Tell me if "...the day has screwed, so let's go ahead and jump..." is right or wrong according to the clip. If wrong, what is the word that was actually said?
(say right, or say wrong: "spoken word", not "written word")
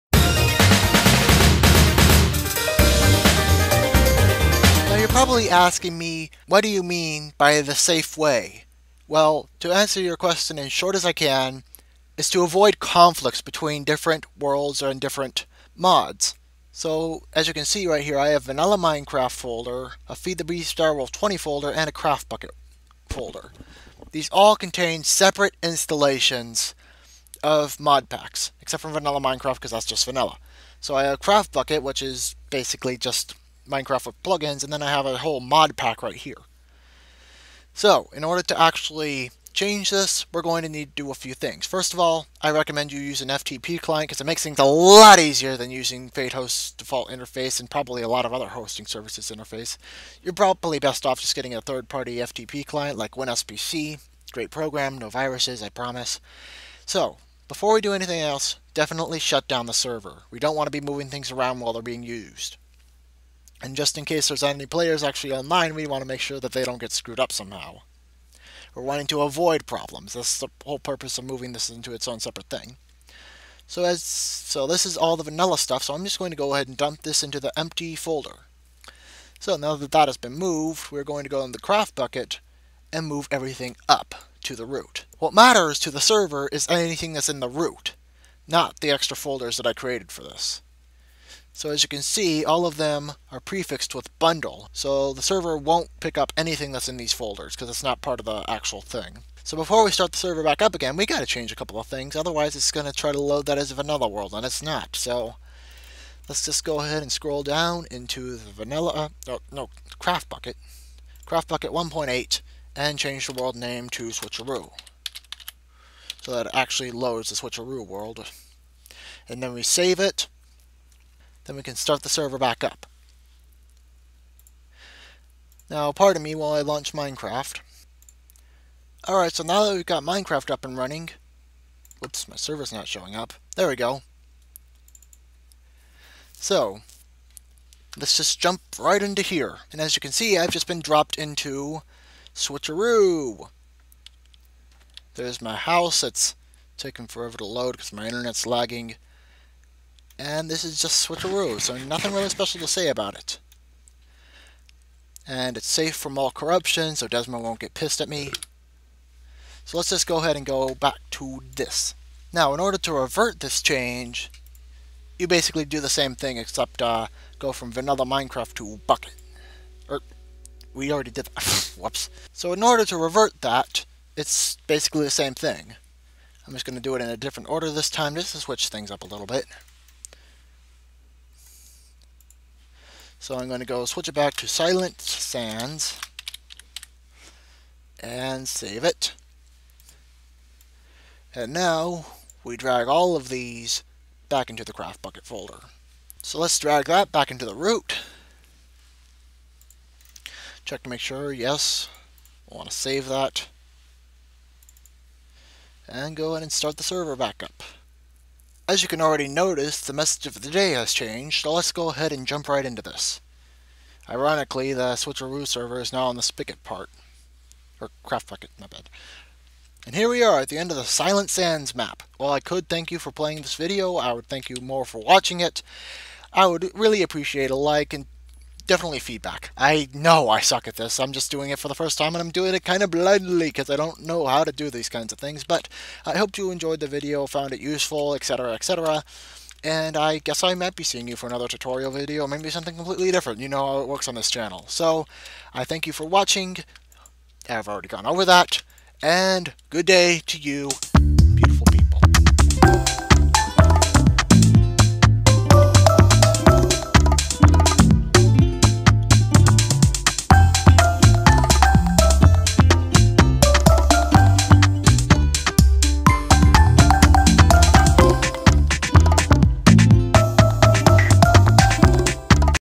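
wrong: "changed", not "screwed".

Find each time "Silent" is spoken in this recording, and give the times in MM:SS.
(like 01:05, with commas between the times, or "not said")
03:04, 03:40.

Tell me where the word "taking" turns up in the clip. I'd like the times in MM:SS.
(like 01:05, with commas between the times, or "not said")
02:26.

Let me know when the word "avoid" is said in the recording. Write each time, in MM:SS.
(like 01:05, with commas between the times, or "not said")
00:12, 01:09.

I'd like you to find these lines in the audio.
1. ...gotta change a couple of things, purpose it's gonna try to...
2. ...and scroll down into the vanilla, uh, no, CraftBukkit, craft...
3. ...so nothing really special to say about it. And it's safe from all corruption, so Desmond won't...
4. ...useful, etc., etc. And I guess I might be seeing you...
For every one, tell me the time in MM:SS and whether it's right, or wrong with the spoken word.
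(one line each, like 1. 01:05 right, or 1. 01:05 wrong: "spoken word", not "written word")
1. 01:41 wrong: "otherwise", not "purpose"
2. 01:47 right
3. 02:31 right
4. 03:57 right.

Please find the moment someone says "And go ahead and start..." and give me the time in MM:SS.
03:25.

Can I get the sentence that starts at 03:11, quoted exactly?
And now we drag all of these back into the CraftBukkit folder.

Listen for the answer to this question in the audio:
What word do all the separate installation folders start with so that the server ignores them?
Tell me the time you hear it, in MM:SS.
01:34.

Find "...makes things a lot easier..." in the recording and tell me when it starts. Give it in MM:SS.
00:44.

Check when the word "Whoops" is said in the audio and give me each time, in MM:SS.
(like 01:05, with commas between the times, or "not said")
02:11, 02:51.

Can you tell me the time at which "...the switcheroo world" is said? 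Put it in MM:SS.
01:57.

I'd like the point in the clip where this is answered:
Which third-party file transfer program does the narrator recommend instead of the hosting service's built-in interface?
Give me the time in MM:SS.
00:53.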